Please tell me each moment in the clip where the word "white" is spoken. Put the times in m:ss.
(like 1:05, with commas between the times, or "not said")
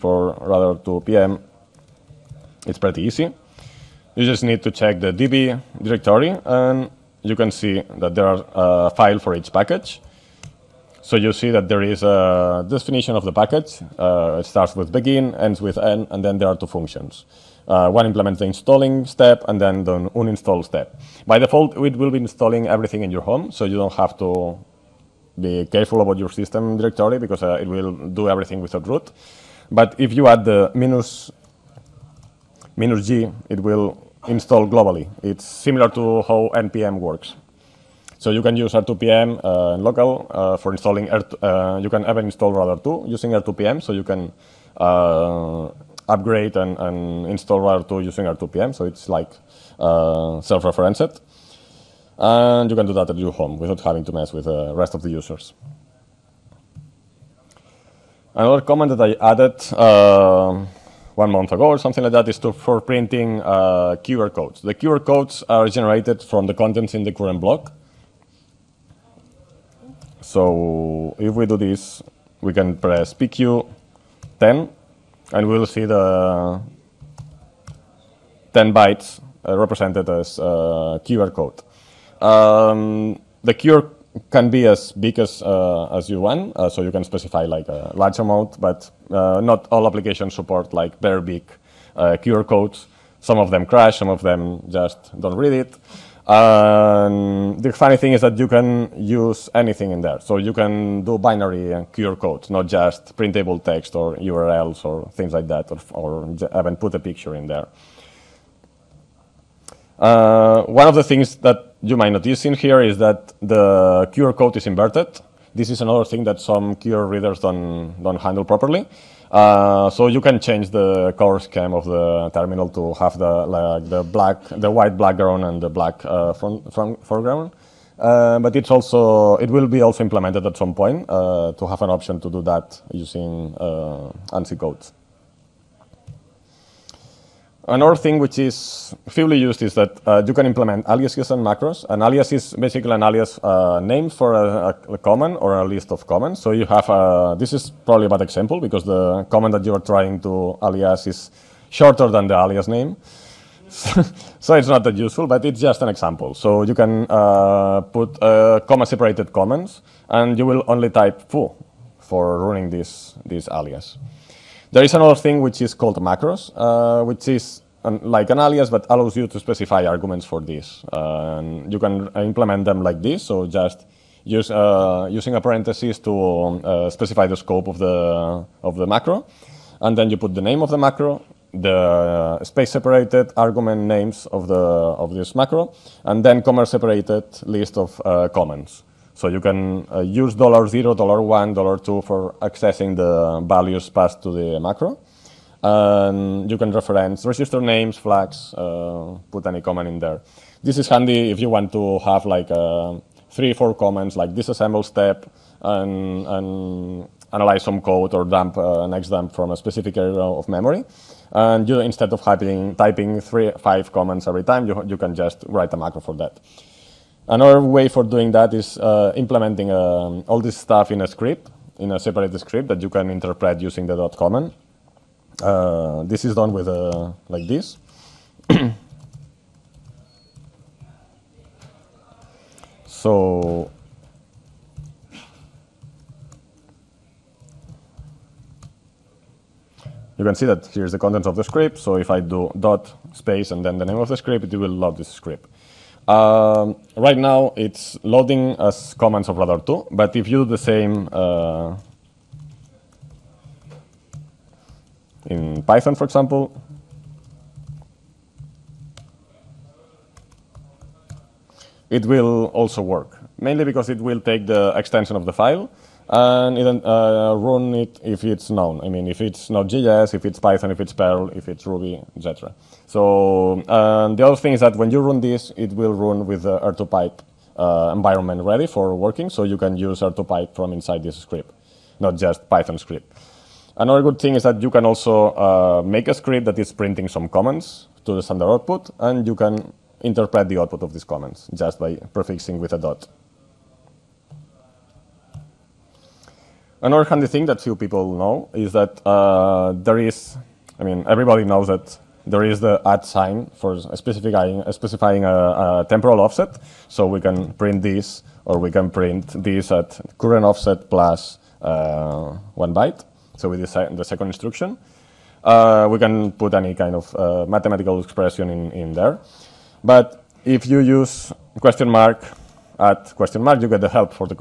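2:04.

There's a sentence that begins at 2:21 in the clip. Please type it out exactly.
An alias is basically an alias uh, name for a, a, command or a list of commands.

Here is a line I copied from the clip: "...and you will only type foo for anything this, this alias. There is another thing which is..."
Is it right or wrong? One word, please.
wrong.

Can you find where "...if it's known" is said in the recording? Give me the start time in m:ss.
4:28.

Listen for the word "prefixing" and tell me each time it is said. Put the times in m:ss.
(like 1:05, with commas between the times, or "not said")
4:52.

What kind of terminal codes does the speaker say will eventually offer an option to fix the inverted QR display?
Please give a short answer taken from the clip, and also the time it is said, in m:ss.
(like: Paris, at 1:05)
ANSI codes, at 2:14.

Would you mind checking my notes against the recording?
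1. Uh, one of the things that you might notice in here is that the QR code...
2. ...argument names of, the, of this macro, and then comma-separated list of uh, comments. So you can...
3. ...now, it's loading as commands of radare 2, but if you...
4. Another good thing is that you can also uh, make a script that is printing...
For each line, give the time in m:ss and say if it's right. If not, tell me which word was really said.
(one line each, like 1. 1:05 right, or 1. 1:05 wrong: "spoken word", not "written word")
1. 1:49 right
2. 3:03 right
3. 4:07 right
4. 4:43 right.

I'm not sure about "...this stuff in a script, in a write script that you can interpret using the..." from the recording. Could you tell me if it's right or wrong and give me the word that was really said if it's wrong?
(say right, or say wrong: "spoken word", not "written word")
wrong: "separate", not "write".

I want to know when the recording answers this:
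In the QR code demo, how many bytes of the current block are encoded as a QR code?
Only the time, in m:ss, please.
1:18.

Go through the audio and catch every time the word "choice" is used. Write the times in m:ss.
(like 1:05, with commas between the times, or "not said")
not said.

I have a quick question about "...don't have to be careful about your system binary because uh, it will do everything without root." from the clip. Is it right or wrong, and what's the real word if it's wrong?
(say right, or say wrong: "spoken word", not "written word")
wrong: "directory", not "binary".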